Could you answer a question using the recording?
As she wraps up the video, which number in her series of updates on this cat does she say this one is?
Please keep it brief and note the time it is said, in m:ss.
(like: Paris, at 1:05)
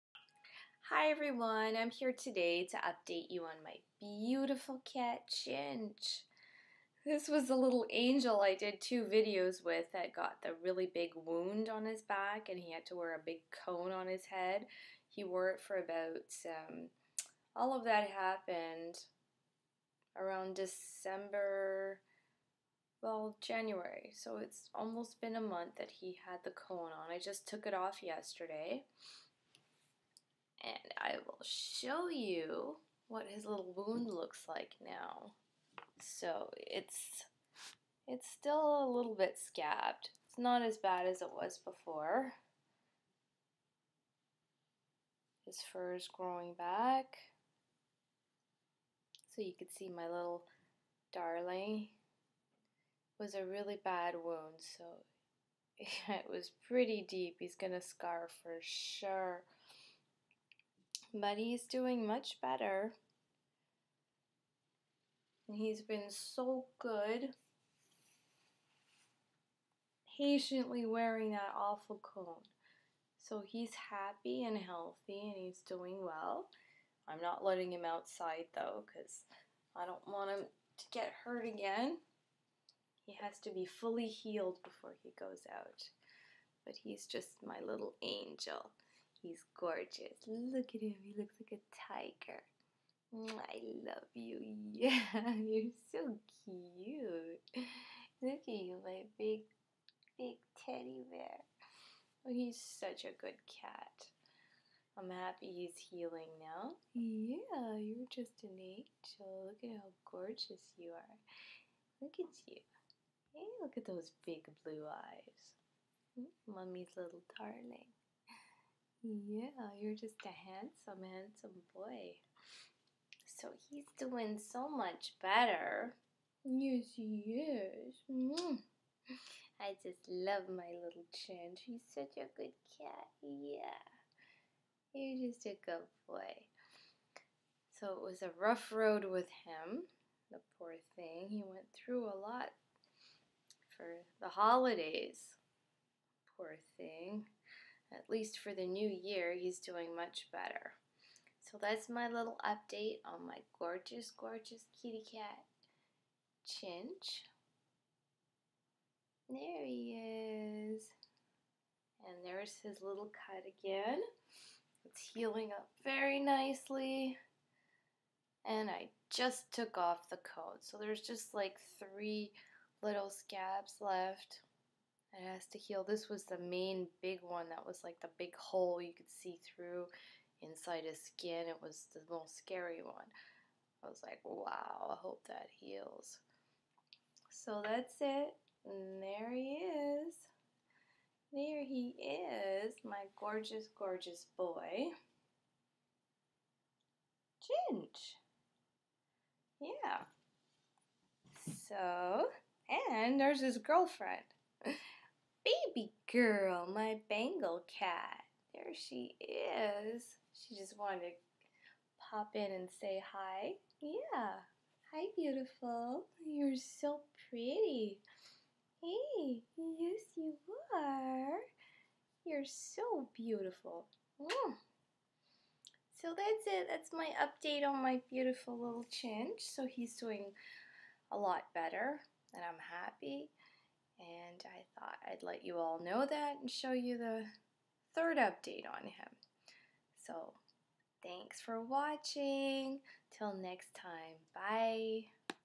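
third, at 3:57.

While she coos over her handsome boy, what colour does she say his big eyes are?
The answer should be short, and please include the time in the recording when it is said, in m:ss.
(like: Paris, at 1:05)
blue, at 1:54.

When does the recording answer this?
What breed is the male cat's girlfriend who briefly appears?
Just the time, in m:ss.
3:27.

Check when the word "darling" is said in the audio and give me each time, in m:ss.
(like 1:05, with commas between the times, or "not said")
0:51, 1:57.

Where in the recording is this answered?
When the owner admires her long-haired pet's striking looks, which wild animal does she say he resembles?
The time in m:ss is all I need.
1:31.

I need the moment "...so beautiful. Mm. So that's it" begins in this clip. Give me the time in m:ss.
3:42.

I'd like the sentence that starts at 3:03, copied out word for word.
I was like, wow, I hope that heals.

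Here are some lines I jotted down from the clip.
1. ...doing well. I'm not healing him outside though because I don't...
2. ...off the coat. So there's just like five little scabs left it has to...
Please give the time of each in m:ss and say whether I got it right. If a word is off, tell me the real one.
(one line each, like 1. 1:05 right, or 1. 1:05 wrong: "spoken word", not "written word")
1. 1:15 wrong: "letting", not "healing"
2. 2:49 wrong: "three", not "five".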